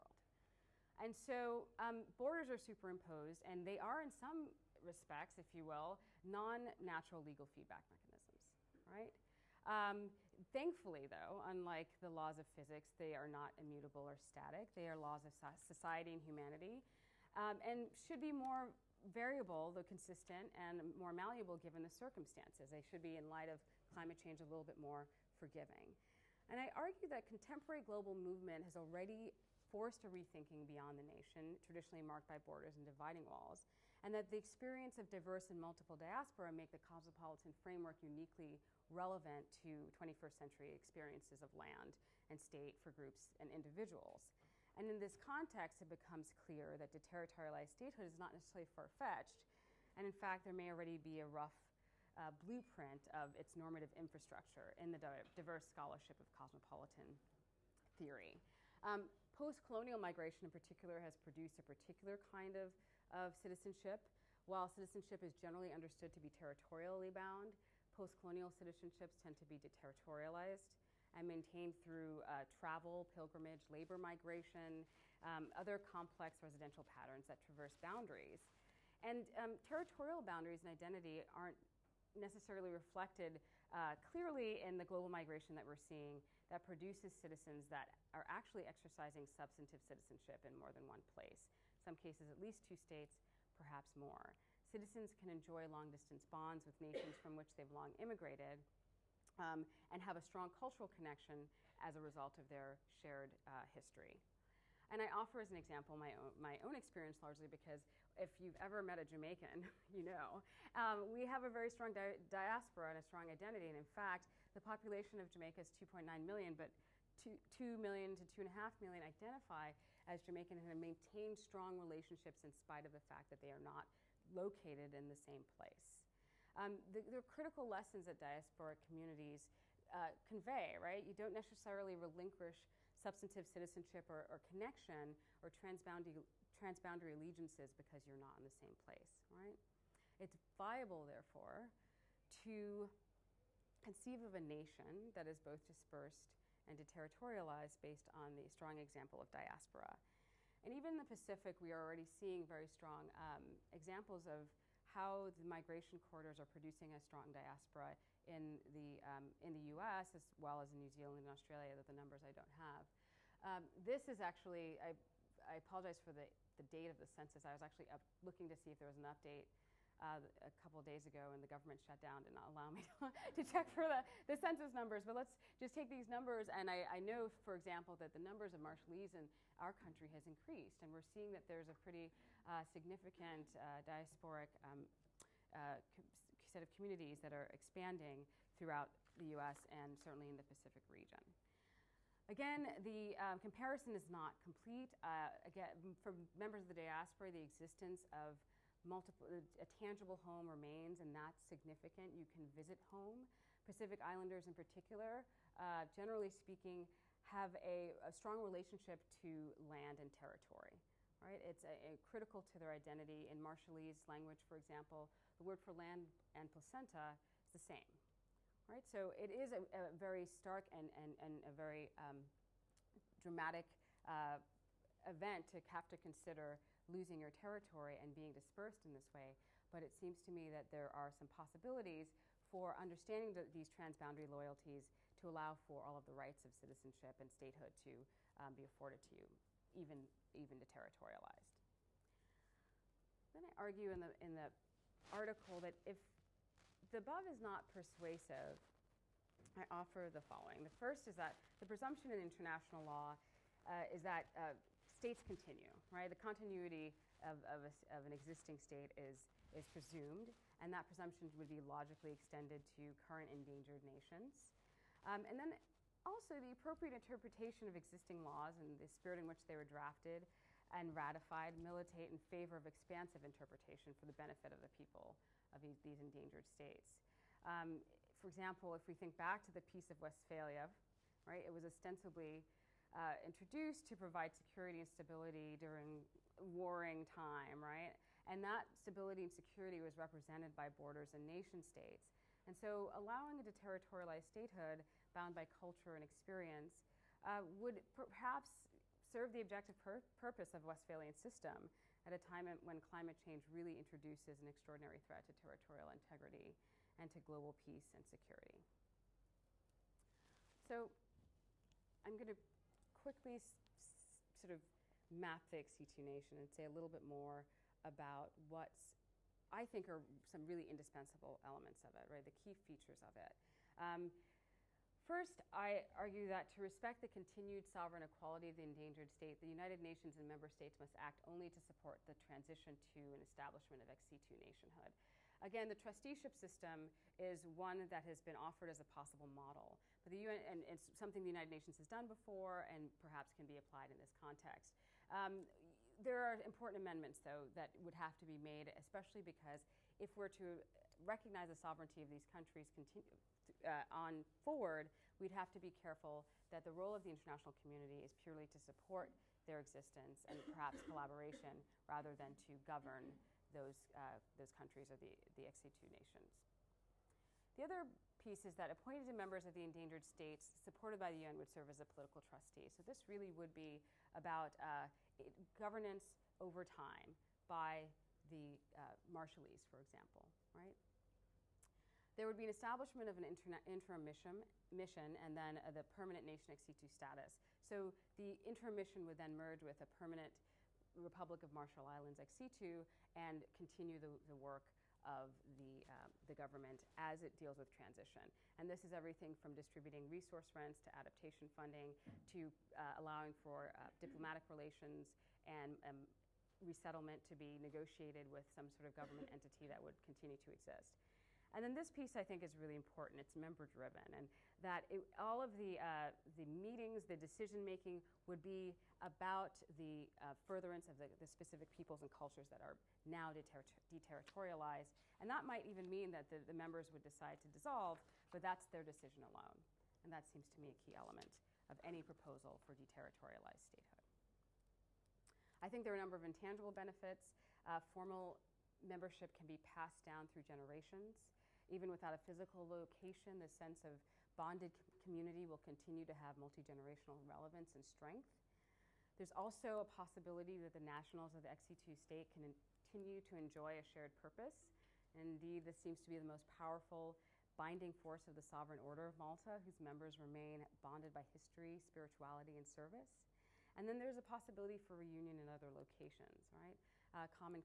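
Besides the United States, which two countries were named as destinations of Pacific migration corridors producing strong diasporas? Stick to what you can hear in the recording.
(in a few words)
New Zealand and Australia.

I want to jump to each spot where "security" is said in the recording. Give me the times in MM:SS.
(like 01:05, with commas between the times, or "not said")
04:44, 04:49, 05:08.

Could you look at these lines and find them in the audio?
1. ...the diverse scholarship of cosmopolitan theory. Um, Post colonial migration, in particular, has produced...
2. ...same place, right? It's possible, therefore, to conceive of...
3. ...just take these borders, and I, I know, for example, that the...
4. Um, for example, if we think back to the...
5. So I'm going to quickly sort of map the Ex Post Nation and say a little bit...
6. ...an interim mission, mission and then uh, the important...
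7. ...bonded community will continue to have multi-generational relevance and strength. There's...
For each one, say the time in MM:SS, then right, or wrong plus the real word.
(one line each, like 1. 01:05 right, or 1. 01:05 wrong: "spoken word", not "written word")
1. 00:54 right
2. 02:18 wrong: "viable", not "possible"
3. 02:55 wrong: "numbers", not "borders"
4. 04:37 right
5. 05:10 wrong: "Situ", not "Post"
6. 06:23 wrong: "permanent", not "important"
7. 07:24 right.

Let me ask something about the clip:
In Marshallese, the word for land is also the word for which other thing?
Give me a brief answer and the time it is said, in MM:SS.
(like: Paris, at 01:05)
placenta, at 03:36.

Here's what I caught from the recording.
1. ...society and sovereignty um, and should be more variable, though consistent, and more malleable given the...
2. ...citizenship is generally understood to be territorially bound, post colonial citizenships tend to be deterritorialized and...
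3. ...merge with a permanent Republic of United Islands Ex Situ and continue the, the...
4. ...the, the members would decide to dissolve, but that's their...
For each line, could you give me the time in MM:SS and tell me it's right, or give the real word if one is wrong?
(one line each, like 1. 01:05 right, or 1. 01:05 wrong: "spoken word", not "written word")
1. 00:15 wrong: "humanity", not "sovereignty"
2. 01:04 right
3. 06:29 wrong: "Marshall", not "United"
4. 07:06 right.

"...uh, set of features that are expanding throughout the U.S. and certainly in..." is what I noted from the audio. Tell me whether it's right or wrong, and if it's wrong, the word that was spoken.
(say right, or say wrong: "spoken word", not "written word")
wrong: "communities", not "features".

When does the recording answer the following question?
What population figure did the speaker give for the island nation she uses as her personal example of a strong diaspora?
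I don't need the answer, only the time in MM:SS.
01:55.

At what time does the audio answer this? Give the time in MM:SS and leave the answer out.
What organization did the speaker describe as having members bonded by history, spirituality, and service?
07:38.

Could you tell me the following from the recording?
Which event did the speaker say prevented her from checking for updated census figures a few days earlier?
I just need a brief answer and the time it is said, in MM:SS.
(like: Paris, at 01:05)
government shut down, at 02:51.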